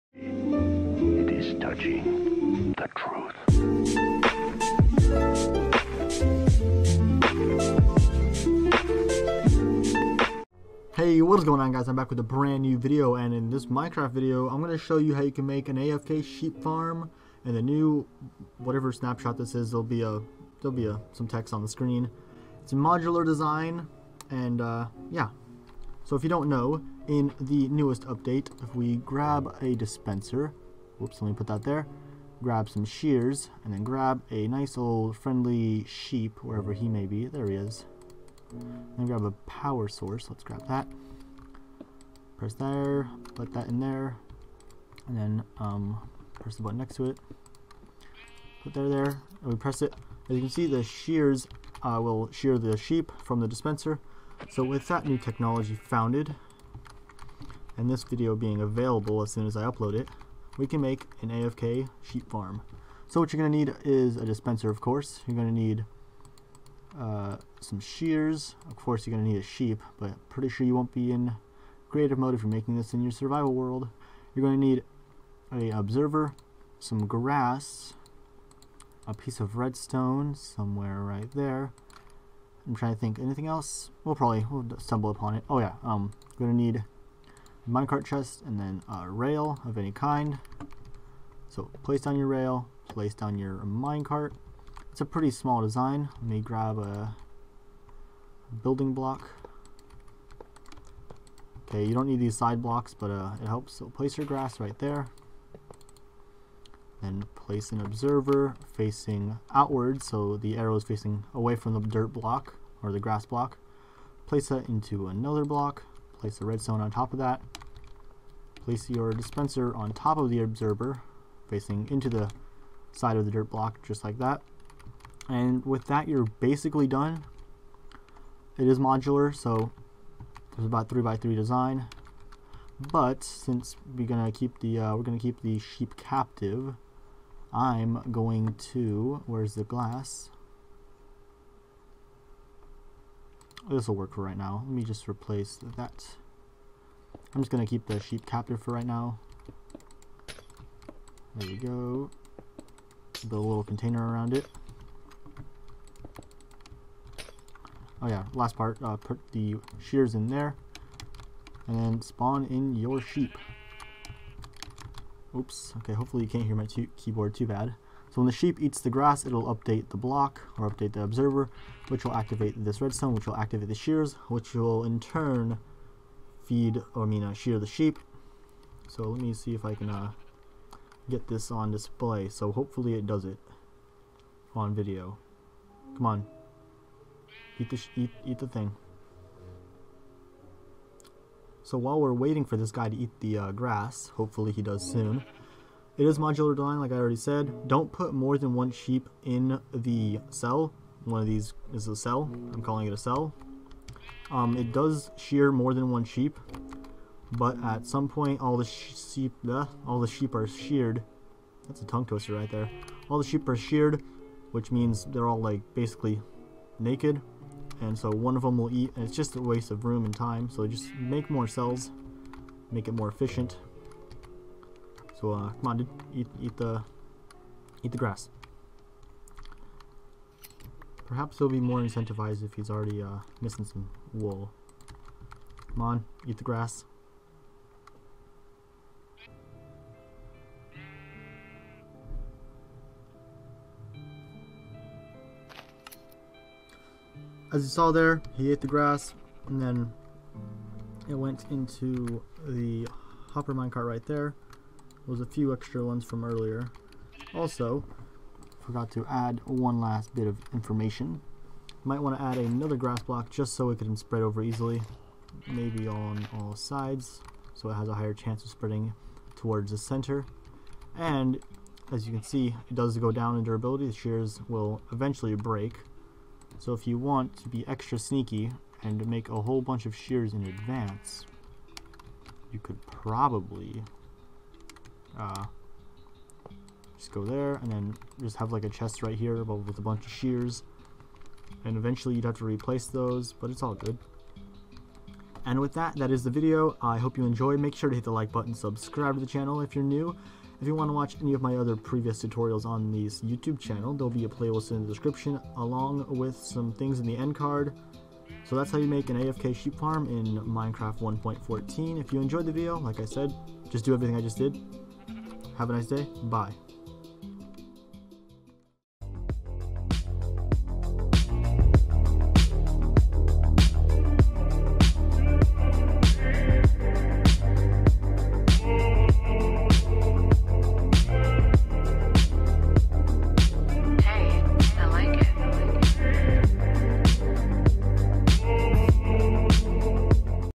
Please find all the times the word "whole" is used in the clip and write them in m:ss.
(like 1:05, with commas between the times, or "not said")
4:39.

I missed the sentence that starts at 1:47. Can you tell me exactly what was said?
Then place an observer facing outward, so the arrow is facing away from the dirt block or the grass block.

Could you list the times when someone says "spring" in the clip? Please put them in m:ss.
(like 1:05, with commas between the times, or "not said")
not said.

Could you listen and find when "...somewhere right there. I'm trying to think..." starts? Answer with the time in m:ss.
1:20.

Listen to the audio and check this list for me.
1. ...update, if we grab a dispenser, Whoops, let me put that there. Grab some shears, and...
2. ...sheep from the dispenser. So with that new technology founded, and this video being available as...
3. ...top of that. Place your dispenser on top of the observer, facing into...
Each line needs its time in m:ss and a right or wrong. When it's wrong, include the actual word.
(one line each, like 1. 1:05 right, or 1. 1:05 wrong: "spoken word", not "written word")
1. 0:28 right
2. 0:52 right
3. 1:56 right.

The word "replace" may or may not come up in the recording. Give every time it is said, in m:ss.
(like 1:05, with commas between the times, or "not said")
2:25, 4:52.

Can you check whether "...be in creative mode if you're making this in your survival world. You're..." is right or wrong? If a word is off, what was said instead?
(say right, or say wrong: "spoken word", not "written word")
right.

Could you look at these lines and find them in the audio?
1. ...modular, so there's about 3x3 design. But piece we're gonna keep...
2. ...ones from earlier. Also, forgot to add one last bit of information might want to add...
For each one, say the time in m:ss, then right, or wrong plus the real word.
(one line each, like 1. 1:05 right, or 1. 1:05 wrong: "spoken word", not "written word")
1. 2:08 wrong: "since", not "piece"
2. 4:15 right.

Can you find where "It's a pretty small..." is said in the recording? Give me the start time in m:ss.
1:34.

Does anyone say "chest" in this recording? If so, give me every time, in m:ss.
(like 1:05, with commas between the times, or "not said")
1:28, 4:48.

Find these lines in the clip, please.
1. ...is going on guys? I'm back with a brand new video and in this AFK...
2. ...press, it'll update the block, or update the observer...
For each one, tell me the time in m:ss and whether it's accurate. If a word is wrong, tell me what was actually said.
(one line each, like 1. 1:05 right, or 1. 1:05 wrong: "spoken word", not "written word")
1. 0:11 wrong: "Minecraft", not "AFK"
2. 2:48 wrong: "grass", not "press".